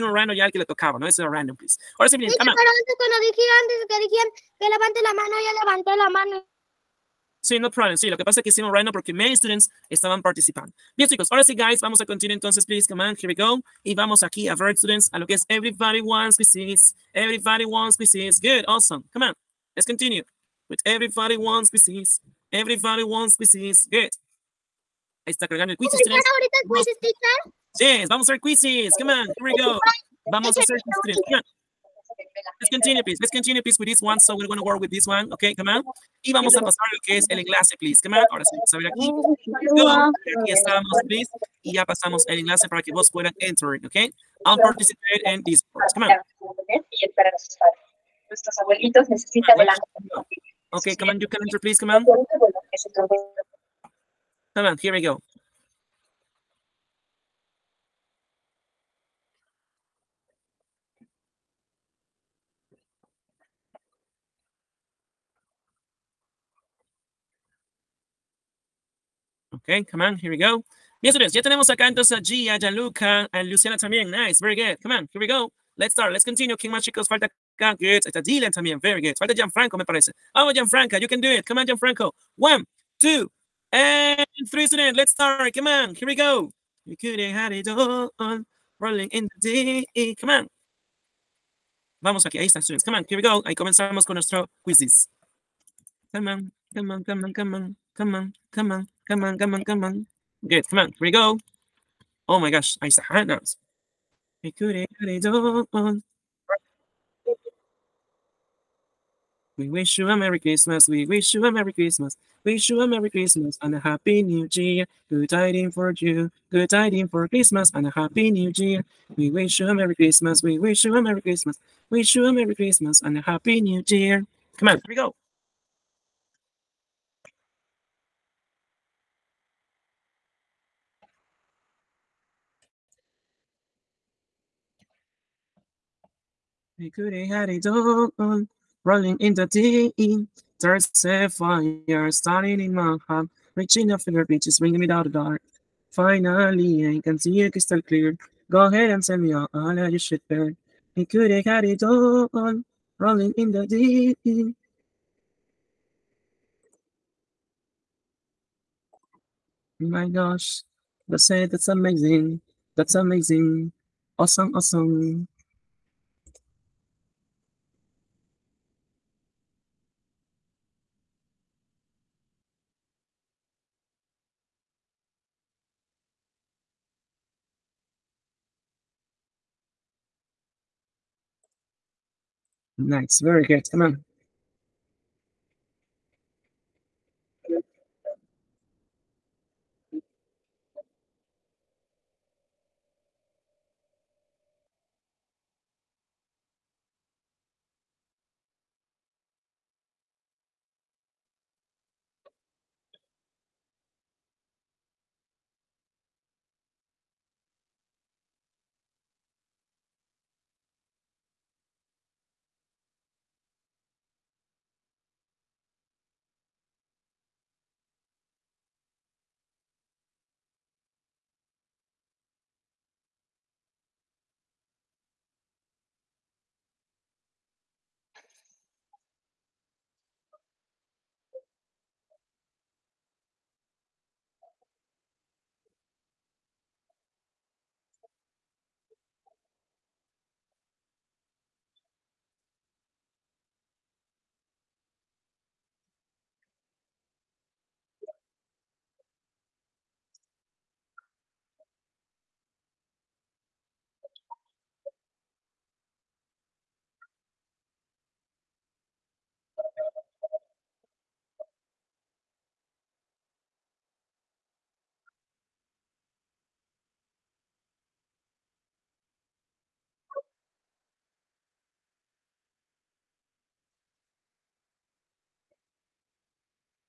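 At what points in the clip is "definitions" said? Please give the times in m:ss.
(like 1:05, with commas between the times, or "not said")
not said.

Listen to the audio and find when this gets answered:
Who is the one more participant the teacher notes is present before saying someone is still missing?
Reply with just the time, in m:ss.
1:18.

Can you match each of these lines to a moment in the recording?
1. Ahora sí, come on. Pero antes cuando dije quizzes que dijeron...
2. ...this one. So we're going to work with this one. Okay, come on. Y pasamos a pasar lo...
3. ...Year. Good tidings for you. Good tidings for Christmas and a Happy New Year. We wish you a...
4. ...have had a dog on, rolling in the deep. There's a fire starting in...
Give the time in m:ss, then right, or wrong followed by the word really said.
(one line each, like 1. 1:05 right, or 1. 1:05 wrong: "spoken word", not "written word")
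1. 0:01 wrong: "antes", not "quizzes"
2. 0:33 wrong: "vamos", not "pasamos"
3. 1:54 right
4. 2:17 right.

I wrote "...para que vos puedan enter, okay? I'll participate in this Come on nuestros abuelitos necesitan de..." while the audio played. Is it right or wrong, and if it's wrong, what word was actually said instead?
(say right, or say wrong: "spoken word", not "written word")
right.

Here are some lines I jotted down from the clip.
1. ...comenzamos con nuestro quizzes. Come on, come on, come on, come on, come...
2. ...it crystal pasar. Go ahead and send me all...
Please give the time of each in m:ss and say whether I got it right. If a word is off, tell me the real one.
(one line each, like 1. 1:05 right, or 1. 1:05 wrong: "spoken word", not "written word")
1. 1:33 right
2. 2:27 wrong: "clear", not "pasar".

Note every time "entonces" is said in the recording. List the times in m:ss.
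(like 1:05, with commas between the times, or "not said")
0:12, 1:11.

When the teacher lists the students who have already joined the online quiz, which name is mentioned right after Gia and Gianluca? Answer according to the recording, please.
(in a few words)
Luciana.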